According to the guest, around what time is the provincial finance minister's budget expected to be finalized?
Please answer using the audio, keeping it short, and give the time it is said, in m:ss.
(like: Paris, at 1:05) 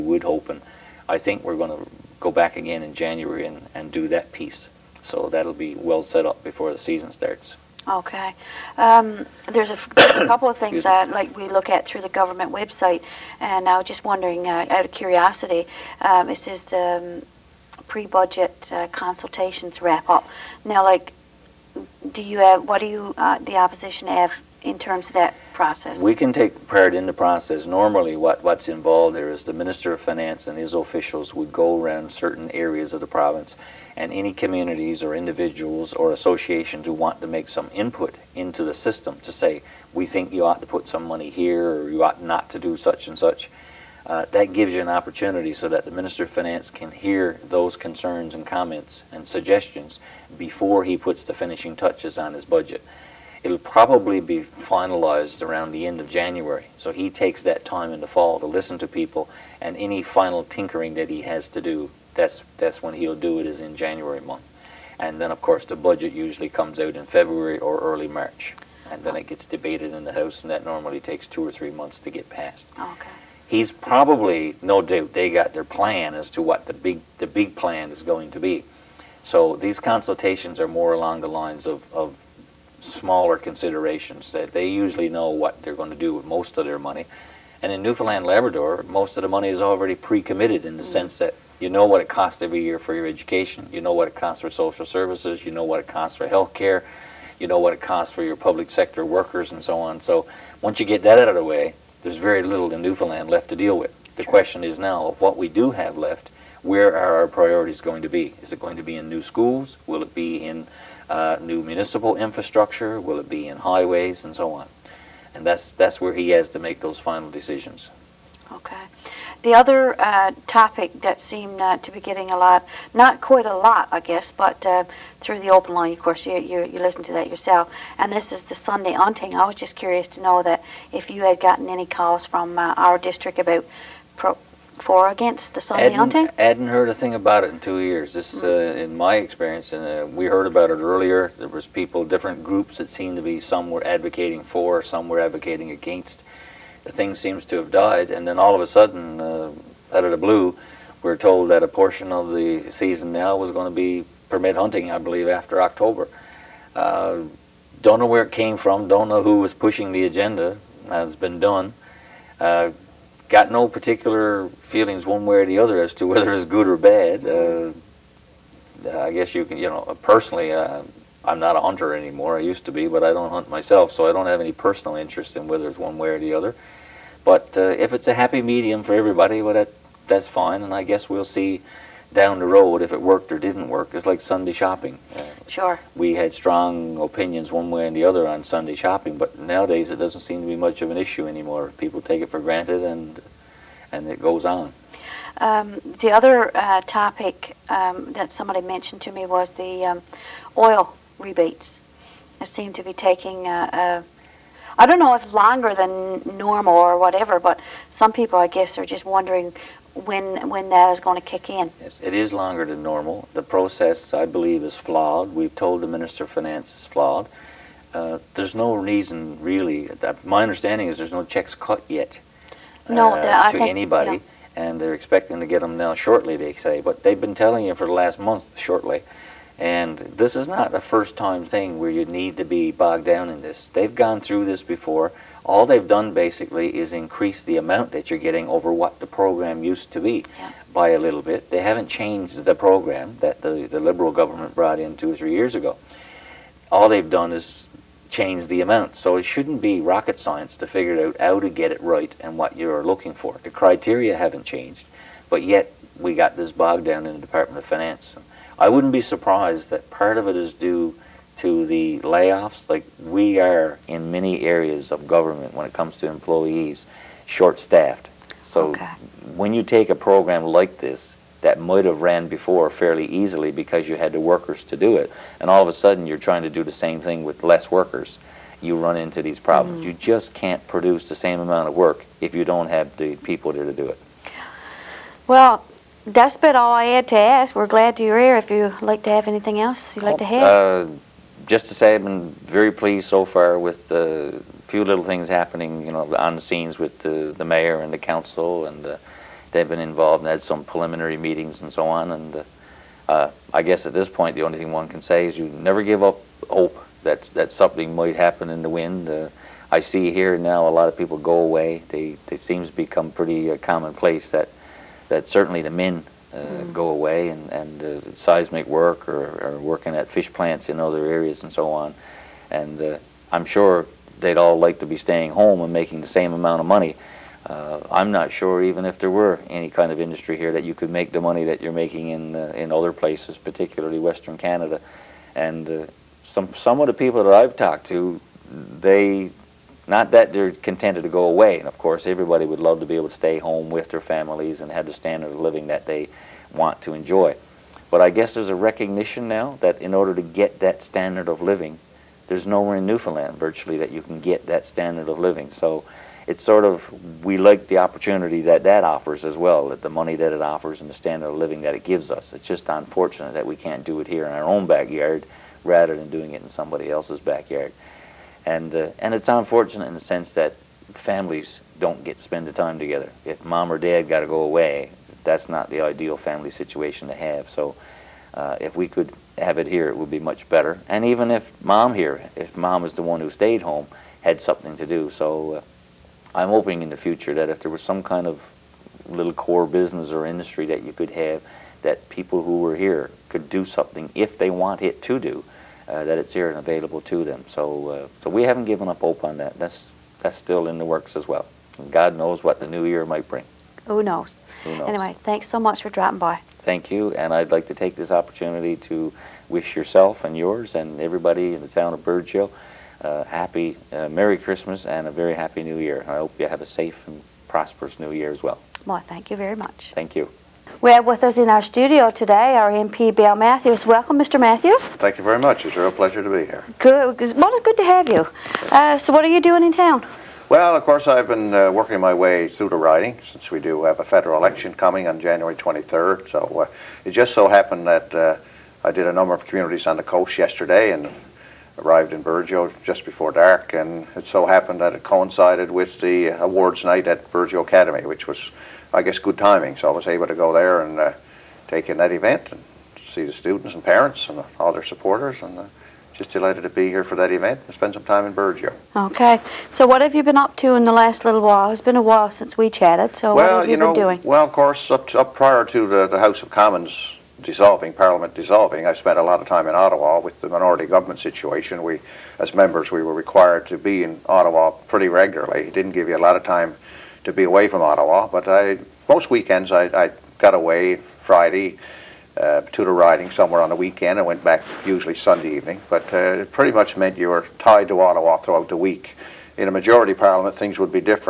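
End of January, at 0:55.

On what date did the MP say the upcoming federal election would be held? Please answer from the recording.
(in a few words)
January 23.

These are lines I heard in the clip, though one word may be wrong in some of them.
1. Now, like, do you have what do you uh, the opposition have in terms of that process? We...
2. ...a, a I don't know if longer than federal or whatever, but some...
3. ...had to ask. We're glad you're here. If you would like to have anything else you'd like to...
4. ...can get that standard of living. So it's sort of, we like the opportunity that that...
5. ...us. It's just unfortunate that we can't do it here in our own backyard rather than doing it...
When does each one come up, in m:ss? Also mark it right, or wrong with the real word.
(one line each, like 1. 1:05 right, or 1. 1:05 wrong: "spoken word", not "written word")
1. 0:20 right
2. 3:23 wrong: "normal", not "federal"
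3. 4:46 right
4. 5:54 right
5. 6:02 right.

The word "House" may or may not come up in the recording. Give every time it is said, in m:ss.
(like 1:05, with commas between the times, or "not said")
1:10, 7:46.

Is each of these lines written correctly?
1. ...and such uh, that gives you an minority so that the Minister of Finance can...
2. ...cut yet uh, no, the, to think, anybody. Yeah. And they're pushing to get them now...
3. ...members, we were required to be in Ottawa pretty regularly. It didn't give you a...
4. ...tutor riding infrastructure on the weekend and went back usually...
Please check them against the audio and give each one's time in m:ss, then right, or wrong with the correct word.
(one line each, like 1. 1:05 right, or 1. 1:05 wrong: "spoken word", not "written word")
1. 0:43 wrong: "opportunity", not "minority"
2. 3:41 wrong: "expecting", not "pushing"
3. 7:52 right
4. 8:02 wrong: "somewhere", not "infrastructure".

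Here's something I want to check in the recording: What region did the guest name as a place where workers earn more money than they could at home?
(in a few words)
Western Canada.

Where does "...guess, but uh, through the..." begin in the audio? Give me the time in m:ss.
2:04.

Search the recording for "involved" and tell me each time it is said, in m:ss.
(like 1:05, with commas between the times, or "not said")
0:28, 4:59.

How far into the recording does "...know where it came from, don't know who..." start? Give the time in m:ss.
2:37.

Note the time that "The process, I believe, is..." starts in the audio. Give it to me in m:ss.
3:33.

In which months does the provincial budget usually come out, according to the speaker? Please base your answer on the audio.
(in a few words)
February or early March.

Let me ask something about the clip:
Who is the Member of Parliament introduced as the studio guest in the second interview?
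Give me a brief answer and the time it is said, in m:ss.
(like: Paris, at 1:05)
Bill Matthews, at 7:03.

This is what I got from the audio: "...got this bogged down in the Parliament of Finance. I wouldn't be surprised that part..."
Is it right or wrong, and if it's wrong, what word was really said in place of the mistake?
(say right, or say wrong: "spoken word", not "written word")
wrong: "Department", not "Parliament".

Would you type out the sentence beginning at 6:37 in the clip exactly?
So, uh, so we haven't given up hope on that.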